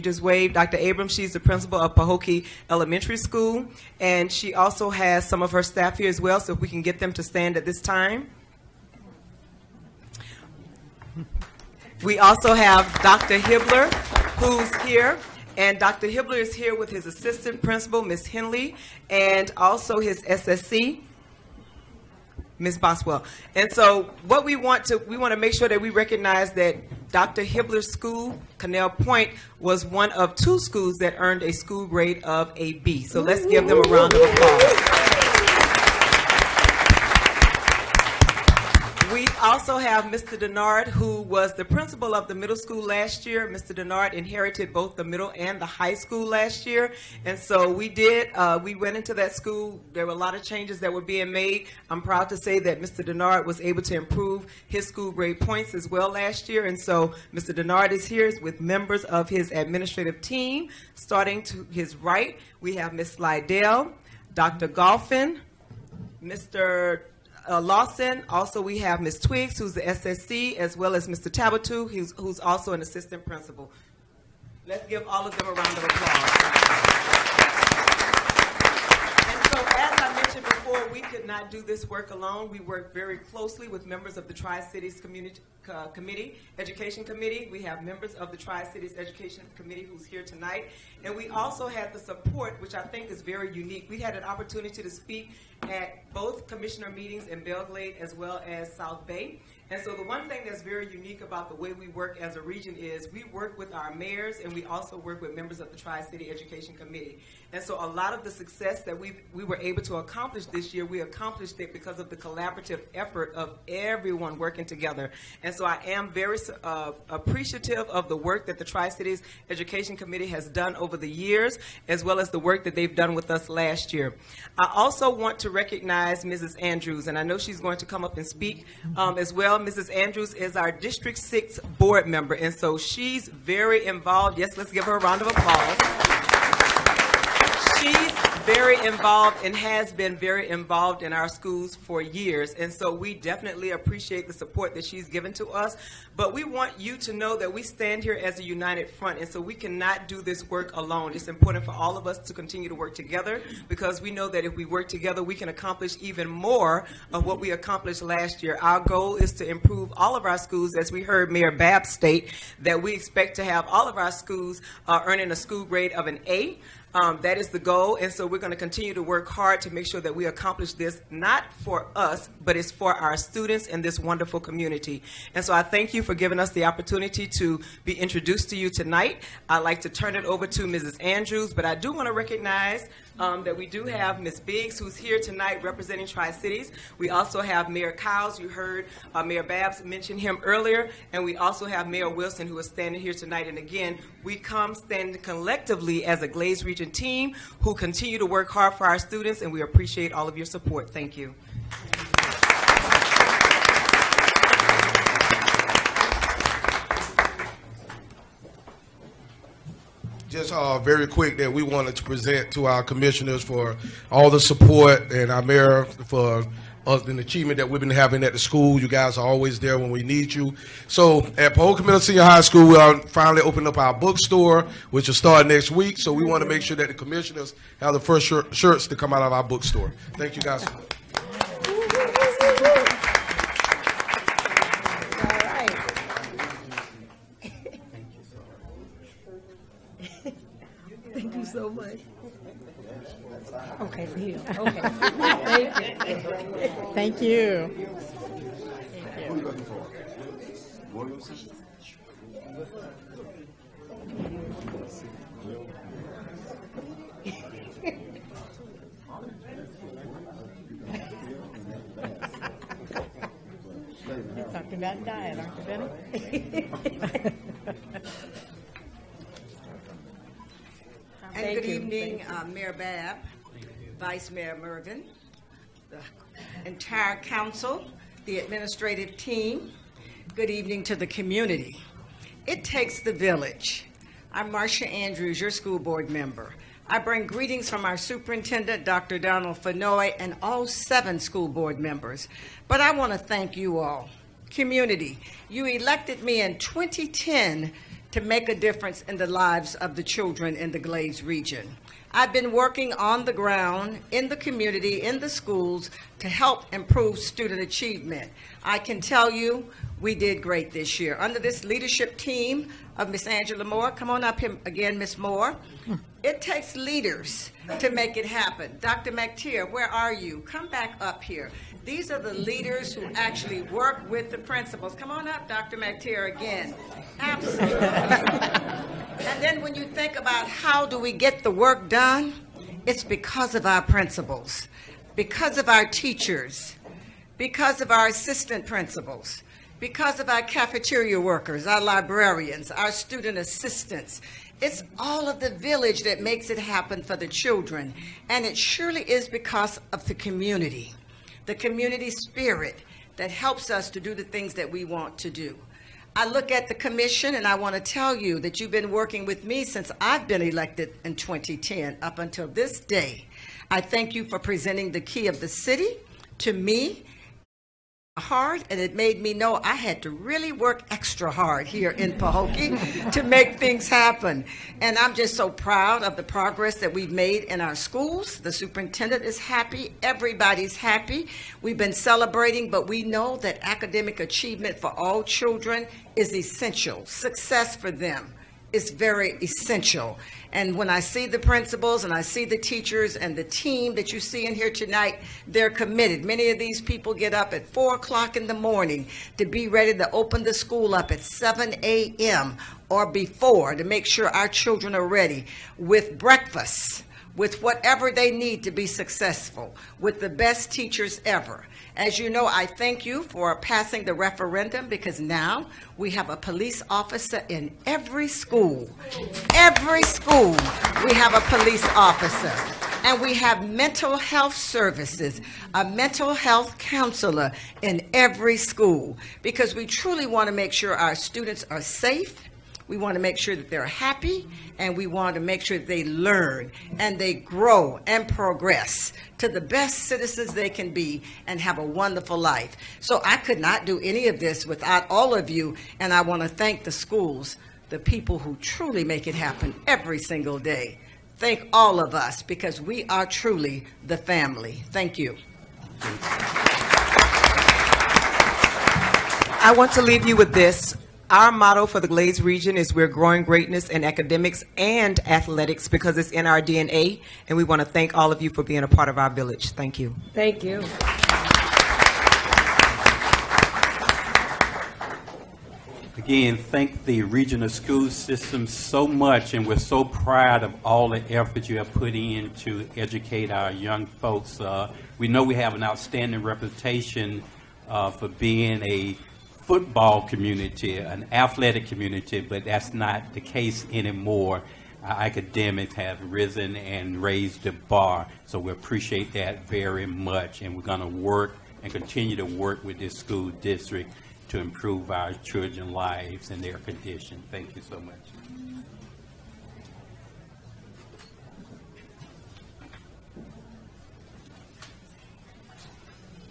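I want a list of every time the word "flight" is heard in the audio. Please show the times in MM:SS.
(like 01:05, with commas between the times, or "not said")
not said.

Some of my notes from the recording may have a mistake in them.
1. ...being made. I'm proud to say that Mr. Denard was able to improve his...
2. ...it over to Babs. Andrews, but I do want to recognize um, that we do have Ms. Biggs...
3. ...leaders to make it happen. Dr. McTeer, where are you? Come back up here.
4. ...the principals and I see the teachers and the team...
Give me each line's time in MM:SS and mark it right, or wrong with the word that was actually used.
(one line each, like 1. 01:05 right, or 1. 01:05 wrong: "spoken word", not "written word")
1. 00:51 right
2. 03:00 wrong: "Mrs", not "Babs"
3. 05:16 right
4. 06:31 right.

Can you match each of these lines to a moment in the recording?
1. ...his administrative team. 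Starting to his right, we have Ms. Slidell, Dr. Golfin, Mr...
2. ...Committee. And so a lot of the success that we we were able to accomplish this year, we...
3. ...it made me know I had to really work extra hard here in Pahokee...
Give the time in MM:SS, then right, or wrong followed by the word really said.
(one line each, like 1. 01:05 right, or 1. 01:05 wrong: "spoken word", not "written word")
1. 00:59 right
2. 01:46 right
3. 06:08 right.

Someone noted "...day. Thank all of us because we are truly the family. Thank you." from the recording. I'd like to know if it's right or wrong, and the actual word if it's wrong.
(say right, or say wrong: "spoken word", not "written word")
right.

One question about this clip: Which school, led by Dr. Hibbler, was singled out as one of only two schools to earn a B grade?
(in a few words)
Canal Point.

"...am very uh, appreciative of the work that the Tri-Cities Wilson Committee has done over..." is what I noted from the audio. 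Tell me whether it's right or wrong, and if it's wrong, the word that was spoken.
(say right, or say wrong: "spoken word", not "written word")
wrong: "Education", not "Wilson".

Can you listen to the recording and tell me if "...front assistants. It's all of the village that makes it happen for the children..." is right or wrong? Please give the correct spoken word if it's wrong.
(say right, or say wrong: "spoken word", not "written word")
wrong: "student", not "front".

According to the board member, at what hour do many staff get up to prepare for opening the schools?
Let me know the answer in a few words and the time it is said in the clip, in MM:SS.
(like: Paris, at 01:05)
4 o'clock, at 06:37.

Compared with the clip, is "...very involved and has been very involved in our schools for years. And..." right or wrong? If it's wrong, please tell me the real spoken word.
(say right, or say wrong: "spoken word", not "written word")
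right.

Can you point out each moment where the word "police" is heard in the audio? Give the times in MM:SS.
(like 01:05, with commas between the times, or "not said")
06:56, 07:01.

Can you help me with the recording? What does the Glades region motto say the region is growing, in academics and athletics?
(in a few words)
greatness.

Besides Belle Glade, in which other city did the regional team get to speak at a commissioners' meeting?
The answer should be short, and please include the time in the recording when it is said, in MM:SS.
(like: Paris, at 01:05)
South Bay, at 01:38.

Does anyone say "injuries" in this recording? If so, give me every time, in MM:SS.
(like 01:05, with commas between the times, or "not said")
not said.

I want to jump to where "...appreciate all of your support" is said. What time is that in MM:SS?
03:19.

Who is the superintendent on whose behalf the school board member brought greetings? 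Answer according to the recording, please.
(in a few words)
Dr. Donald Fennoy.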